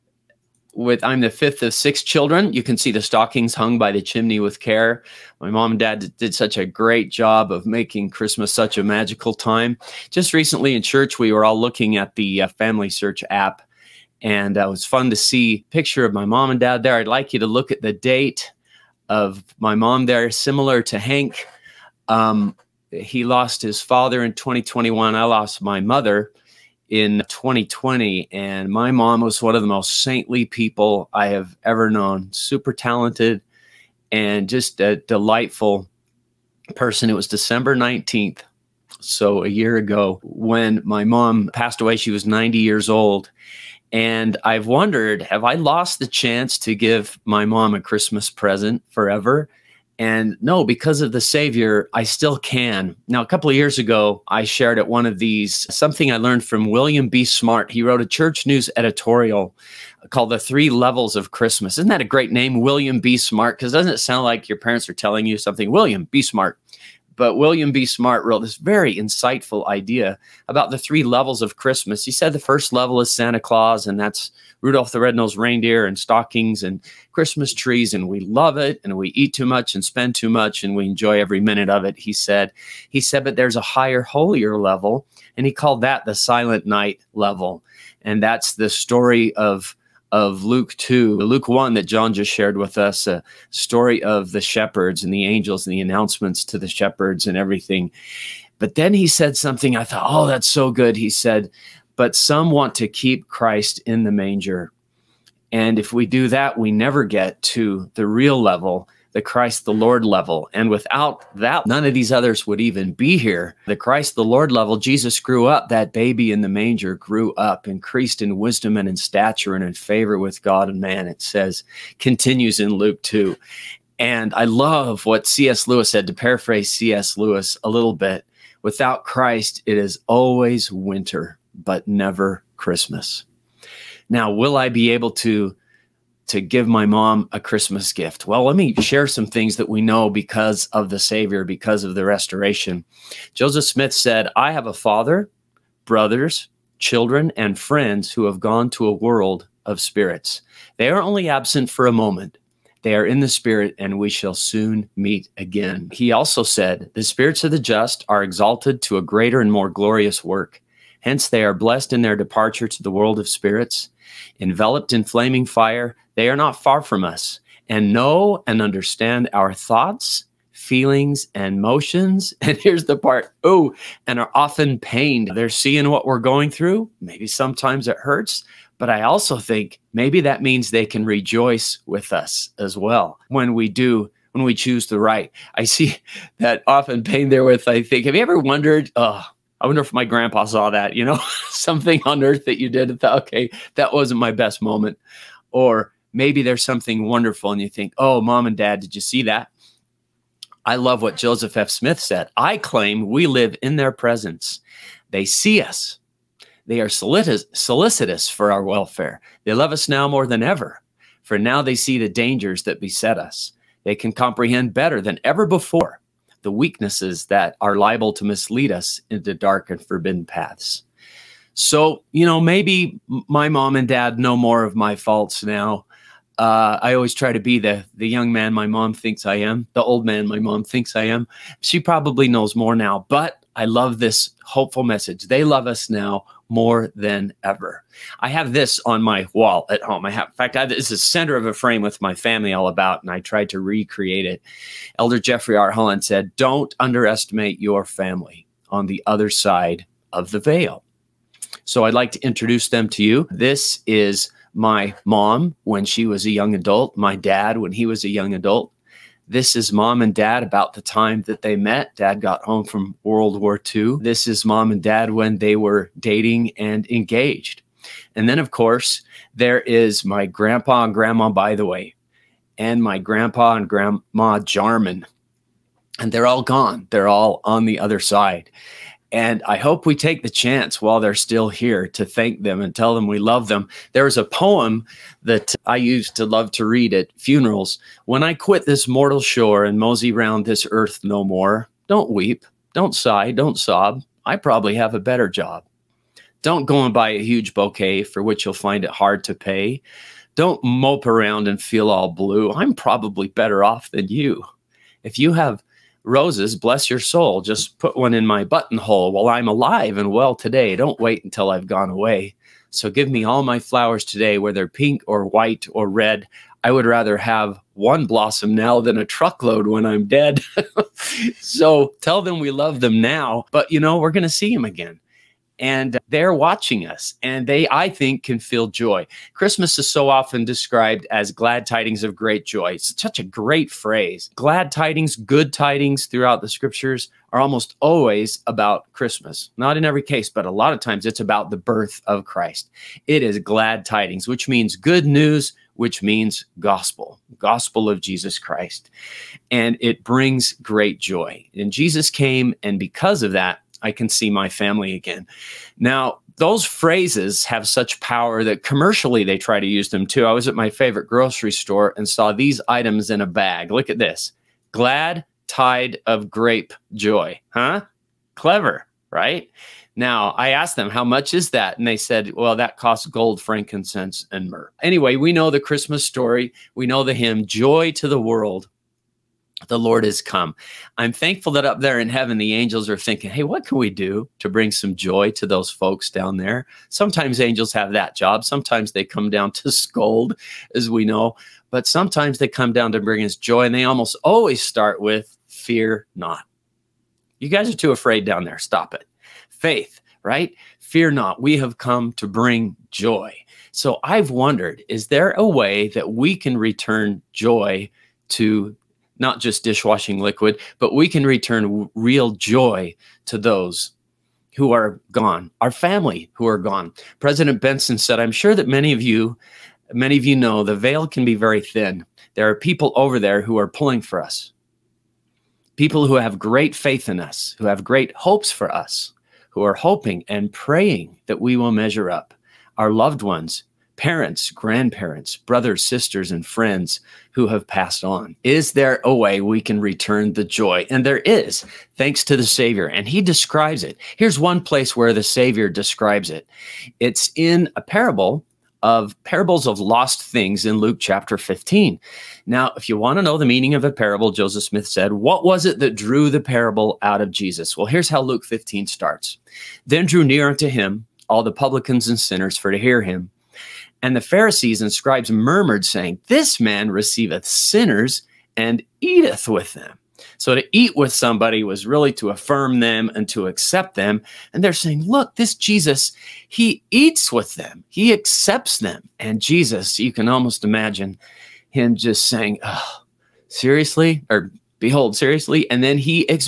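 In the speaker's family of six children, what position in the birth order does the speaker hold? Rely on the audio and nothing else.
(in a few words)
fifth.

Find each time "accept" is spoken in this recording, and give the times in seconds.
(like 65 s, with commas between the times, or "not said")
473 s, 478 s.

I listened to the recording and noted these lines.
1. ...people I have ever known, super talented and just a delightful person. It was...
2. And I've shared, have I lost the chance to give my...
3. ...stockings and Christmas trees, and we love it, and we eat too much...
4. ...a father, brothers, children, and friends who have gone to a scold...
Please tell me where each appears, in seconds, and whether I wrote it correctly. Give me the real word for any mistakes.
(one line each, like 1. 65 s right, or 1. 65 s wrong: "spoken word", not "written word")
1. 30 s right
2. 43 s wrong: "wondered", not "shared"
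3. 75 s right
4. 144 s wrong: "world", not "scold".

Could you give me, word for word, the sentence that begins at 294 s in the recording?
I probably have a better job.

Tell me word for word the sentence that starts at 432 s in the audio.
Our loved ones parents, grandparents, brothers, sisters, and friends who have passed on?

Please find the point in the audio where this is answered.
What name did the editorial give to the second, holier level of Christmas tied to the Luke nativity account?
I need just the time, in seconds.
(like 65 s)
86 s.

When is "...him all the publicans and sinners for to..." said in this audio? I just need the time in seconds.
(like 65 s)
460 s.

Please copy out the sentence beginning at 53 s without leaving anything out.
Now, a couple of years ago, I shared at one of these something I learned from William B.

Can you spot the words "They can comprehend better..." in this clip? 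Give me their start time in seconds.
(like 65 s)
213 s.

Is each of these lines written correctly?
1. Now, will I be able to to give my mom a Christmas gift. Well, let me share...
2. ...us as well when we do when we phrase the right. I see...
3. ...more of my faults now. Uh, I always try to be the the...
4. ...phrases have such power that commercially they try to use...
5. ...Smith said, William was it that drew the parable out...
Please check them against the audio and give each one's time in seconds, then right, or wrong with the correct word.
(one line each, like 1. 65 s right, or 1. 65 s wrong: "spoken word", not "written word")
1. 134 s right
2. 182 s wrong: "choose", not "phrase"
3. 224 s right
4. 356 s right
5. 454 s wrong: "What", not "William".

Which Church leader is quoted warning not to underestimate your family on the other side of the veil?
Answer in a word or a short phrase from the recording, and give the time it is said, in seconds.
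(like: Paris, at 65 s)
Jeffrey R. Holland, at 245 s.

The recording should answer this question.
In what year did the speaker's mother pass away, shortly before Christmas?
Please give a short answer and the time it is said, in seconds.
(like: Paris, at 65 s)
2020, at 27 s.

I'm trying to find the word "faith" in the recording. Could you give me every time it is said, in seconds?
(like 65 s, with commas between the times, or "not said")
399 s, 426 s.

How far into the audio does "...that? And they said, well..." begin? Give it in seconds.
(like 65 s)
371 s.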